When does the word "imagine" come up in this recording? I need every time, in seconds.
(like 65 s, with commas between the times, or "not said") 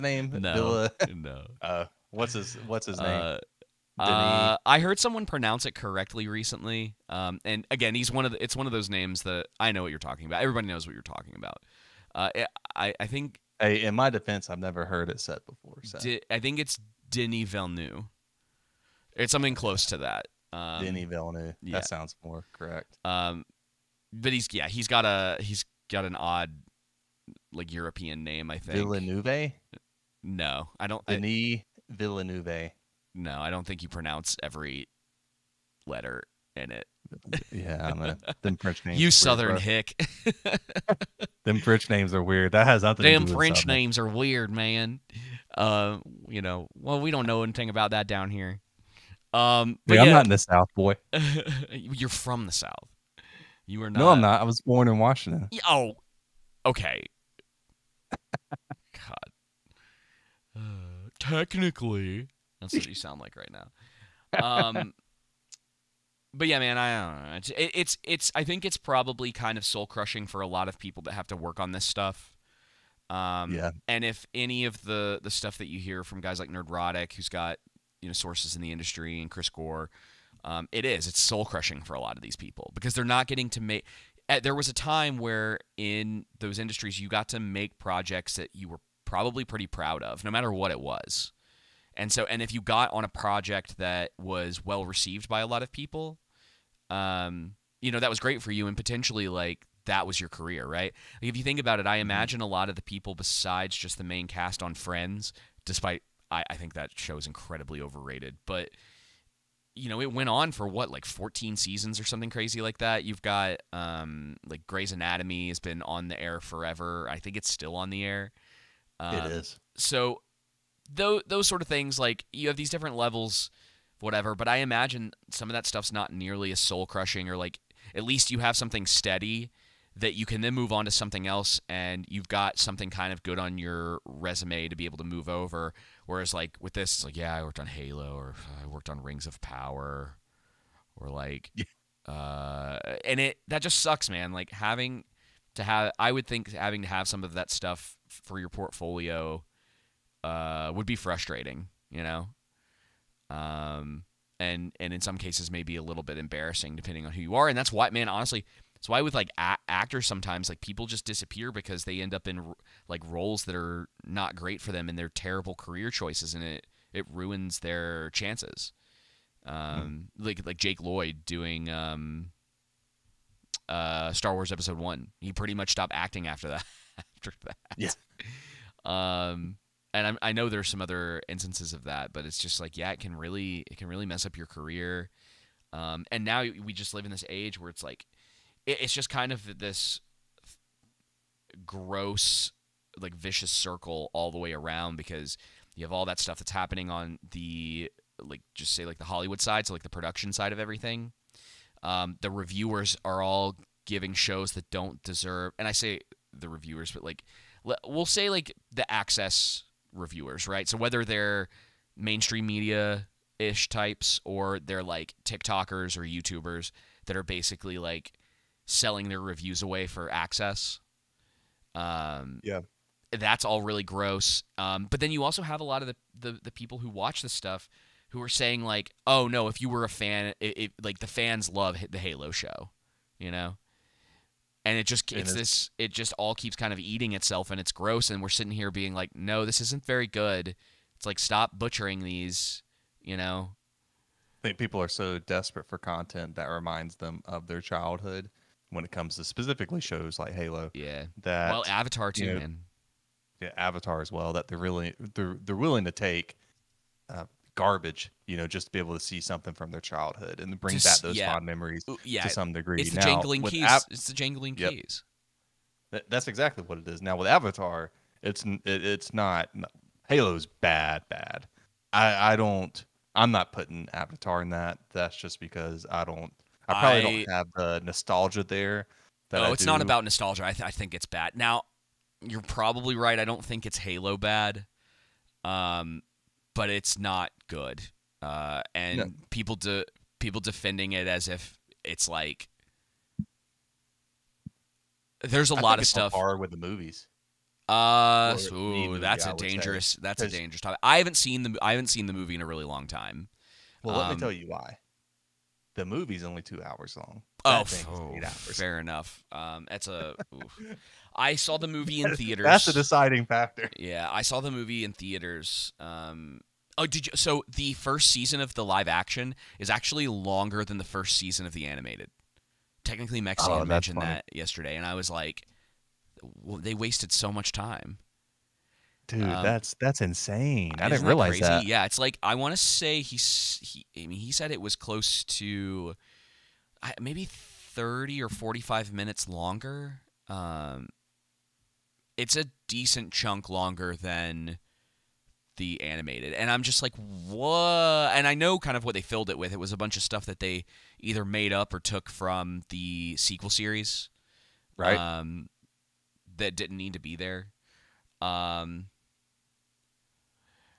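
102 s, 124 s.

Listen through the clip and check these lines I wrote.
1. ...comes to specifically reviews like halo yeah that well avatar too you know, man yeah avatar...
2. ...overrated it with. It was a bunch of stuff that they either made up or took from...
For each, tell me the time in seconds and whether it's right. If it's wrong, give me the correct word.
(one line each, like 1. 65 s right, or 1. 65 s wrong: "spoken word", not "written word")
1. 248 s wrong: "shows", not "reviews"
2. 349 s wrong: "filled", not "overrated".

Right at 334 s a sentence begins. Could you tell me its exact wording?
I mean, he said it was close to maybe thirty or forty-five minutes longer.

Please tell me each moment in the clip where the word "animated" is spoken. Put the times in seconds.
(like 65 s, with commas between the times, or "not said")
321 s, 345 s.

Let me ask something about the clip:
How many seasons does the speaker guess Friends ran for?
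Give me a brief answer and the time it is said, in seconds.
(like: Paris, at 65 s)
14, at 111 s.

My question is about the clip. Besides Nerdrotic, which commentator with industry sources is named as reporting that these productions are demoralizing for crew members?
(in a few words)
Chris Gore.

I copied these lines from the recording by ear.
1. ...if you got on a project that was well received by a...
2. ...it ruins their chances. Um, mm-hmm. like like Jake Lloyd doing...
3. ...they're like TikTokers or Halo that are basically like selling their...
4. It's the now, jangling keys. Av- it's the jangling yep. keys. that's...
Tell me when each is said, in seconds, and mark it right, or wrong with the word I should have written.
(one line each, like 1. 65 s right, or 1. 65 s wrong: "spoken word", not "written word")
1. 92 s right
2. 166 s right
3. 214 s wrong: "YouTubers", not "Halo"
4. 262 s right.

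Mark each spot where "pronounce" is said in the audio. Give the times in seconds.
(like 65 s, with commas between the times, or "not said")
5 s, 33 s.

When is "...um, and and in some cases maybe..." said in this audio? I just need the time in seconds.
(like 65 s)
153 s.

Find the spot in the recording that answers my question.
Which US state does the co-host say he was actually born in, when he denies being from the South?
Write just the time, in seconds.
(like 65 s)
54 s.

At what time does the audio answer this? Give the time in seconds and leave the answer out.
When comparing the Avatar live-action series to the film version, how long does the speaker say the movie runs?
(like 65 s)
306 s.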